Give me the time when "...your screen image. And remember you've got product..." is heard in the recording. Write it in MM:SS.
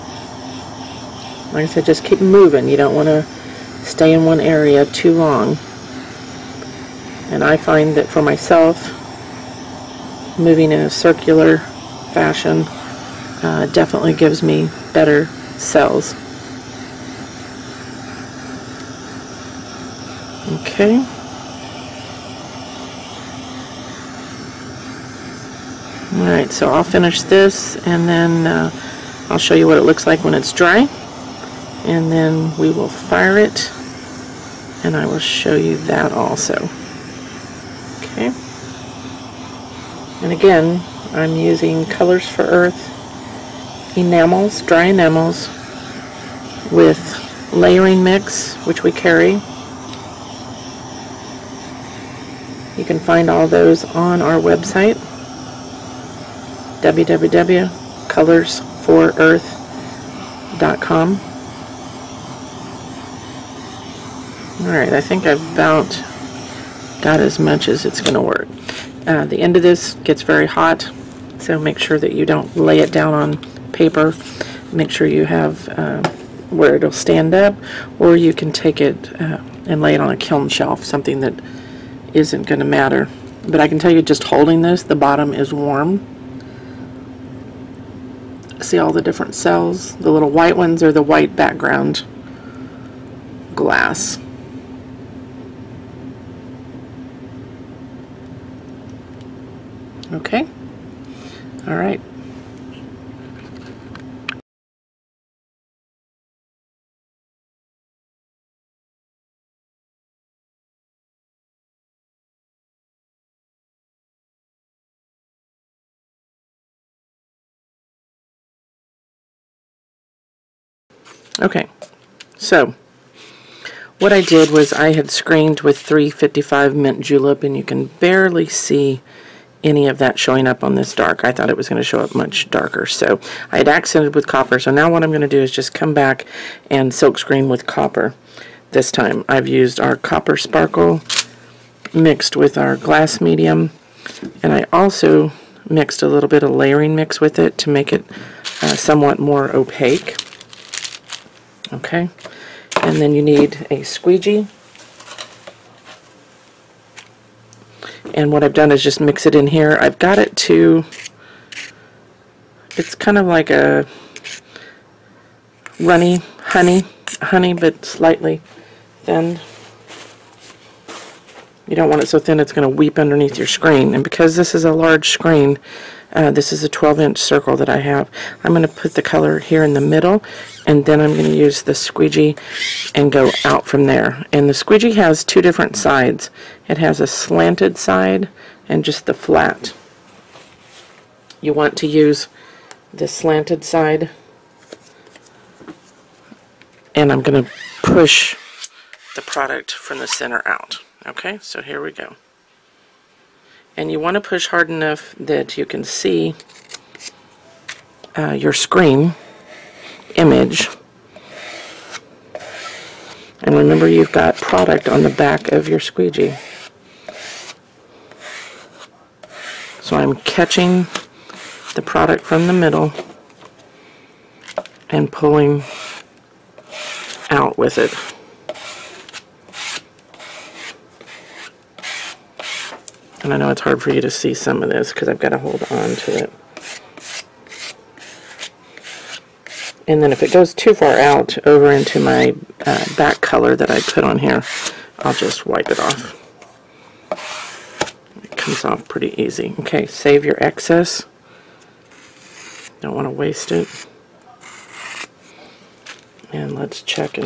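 03:28.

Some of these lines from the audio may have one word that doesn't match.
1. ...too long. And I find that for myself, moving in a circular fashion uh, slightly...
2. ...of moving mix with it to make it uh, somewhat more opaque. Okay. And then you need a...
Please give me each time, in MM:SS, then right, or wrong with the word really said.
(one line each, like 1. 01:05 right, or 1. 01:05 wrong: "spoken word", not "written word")
1. 00:04 wrong: "definitely", not "slightly"
2. 02:26 wrong: "layering", not "moving".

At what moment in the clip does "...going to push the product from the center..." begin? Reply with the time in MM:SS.
03:17.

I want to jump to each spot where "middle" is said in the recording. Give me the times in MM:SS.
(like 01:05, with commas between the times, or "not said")
02:59, 03:42.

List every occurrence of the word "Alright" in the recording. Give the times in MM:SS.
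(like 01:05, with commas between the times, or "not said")
00:26, 01:04.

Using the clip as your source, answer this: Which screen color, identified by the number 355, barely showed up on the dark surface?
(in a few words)
mint julep.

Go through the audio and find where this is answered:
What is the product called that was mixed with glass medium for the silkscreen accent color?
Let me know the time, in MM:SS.
02:19.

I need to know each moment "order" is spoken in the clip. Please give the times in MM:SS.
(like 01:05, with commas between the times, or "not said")
not said.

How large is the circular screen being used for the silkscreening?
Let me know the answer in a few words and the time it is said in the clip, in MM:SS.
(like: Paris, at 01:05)
12-inch, at 02:56.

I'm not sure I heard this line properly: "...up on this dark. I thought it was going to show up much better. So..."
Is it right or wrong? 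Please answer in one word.
wrong.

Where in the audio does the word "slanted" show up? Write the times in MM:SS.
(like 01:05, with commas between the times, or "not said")
03:07, 03:13.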